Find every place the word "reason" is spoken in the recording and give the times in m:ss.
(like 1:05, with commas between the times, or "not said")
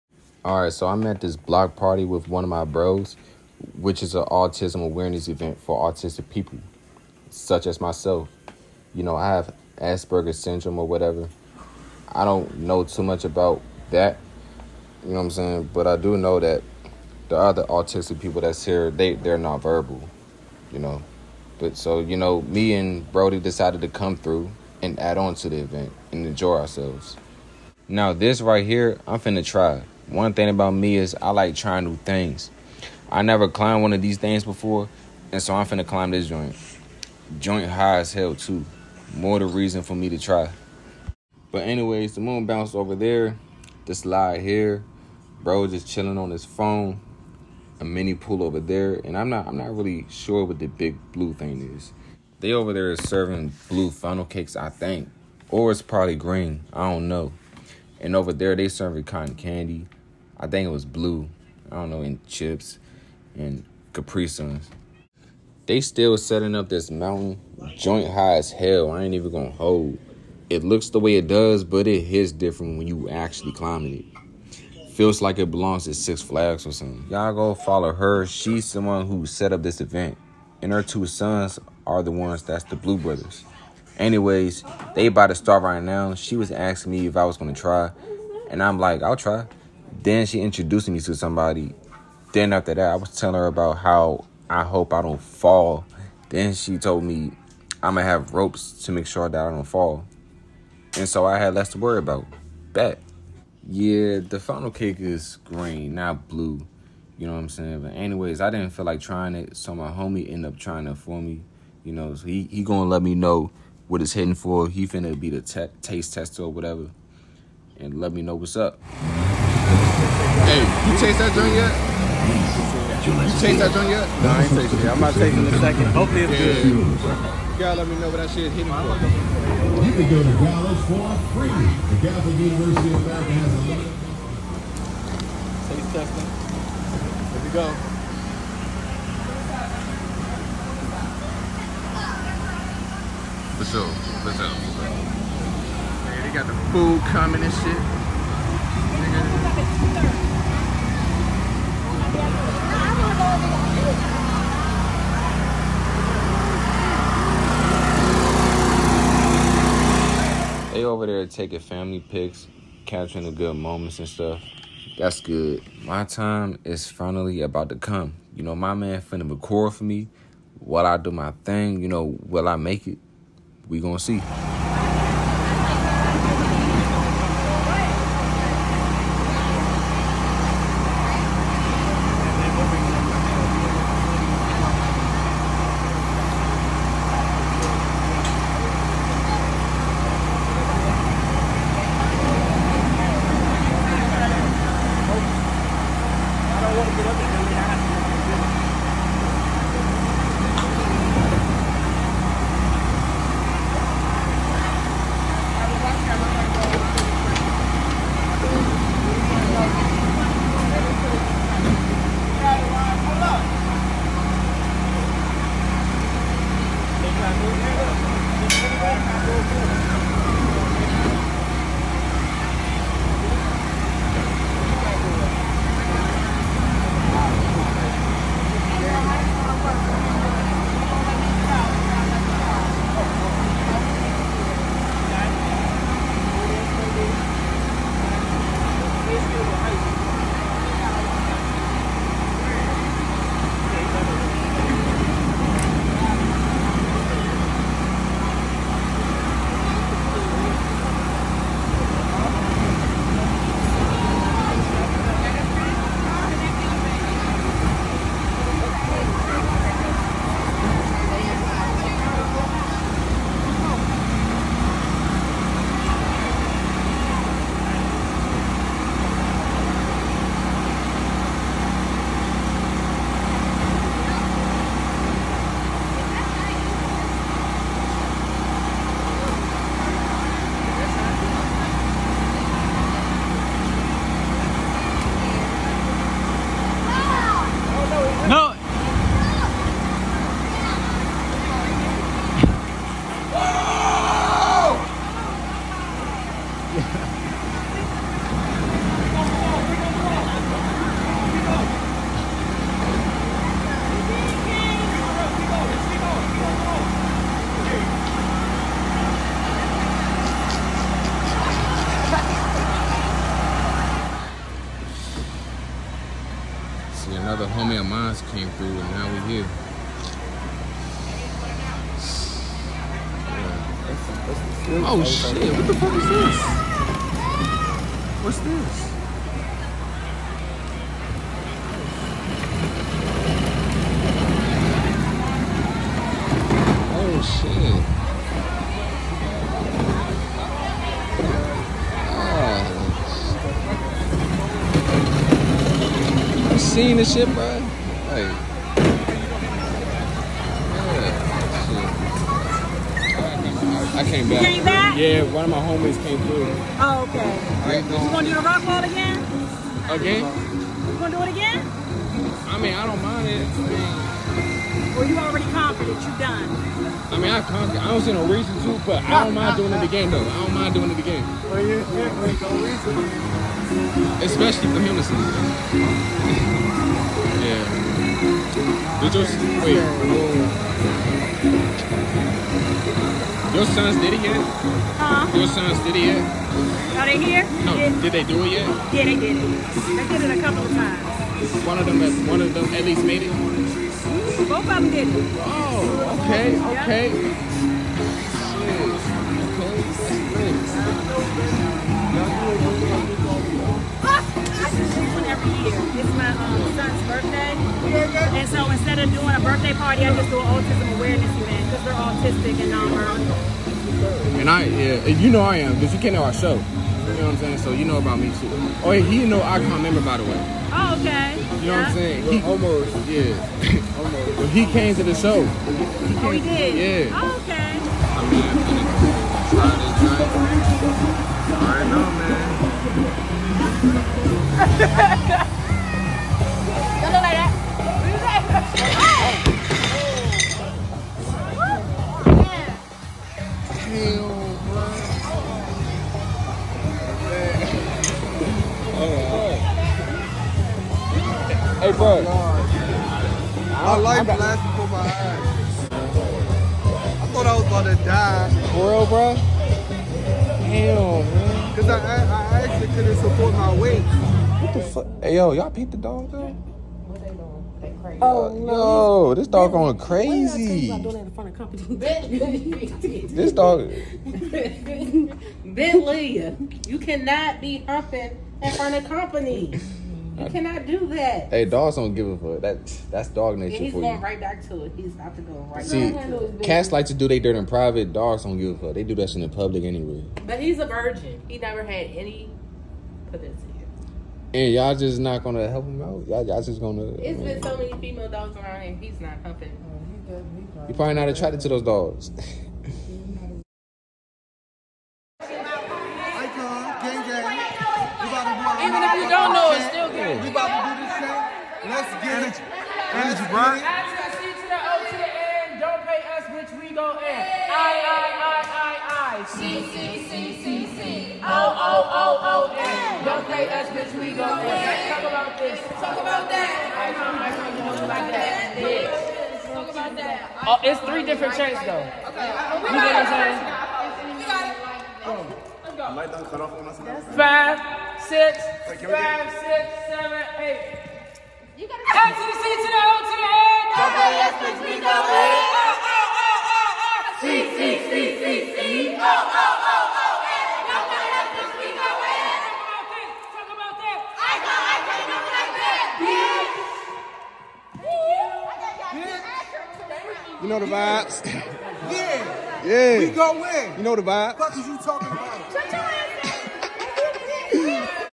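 0:39, 6:08.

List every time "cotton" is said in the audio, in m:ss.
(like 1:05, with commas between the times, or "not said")
0:59.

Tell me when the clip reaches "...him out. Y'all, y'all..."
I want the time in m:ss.
8:15.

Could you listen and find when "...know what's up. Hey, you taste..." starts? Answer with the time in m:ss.
1:58.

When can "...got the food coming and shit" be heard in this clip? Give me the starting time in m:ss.
2:26.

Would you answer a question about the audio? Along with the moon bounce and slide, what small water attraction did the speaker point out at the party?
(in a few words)
mini pool.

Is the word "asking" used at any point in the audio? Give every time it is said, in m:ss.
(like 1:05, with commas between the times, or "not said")
1:26.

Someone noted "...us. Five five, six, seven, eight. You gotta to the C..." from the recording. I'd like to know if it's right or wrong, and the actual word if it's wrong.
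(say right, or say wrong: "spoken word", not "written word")
right.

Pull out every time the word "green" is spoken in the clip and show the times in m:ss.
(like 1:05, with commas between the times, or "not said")
0:56, 1:45.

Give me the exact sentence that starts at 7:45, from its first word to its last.
Hey, yo, y'all peep the dog, though?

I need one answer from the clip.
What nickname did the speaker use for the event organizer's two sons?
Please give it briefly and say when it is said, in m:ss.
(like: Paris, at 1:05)
Blue Brothers, at 1:22.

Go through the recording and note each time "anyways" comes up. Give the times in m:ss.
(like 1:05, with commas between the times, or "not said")
0:41, 1:23, 1:47, 8:09.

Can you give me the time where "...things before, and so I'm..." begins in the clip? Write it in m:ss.
0:34.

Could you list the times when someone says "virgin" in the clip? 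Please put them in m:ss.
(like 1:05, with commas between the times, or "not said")
8:10.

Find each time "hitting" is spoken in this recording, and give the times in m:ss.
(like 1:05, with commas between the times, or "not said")
1:54, 2:08.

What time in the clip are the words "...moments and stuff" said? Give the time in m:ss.
2:43.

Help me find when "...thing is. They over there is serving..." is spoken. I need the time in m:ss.
0:51.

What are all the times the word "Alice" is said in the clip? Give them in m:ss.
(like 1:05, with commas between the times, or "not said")
not said.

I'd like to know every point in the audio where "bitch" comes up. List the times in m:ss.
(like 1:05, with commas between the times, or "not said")
8:36, 8:43, 8:48, 9:20.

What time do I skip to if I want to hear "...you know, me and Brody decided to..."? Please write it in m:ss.
0:21.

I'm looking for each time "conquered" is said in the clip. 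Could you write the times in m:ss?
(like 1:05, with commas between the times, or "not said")
6:07.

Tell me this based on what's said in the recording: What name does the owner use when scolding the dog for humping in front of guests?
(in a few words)
Ben Leah.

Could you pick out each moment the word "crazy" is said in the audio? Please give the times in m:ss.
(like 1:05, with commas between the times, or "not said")
7:49.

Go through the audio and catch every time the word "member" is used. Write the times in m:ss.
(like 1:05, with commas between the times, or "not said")
6:59.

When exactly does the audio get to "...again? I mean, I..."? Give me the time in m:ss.
6:01.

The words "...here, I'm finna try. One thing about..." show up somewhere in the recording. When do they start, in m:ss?
0:28.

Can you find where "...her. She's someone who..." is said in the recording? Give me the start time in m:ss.
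1:17.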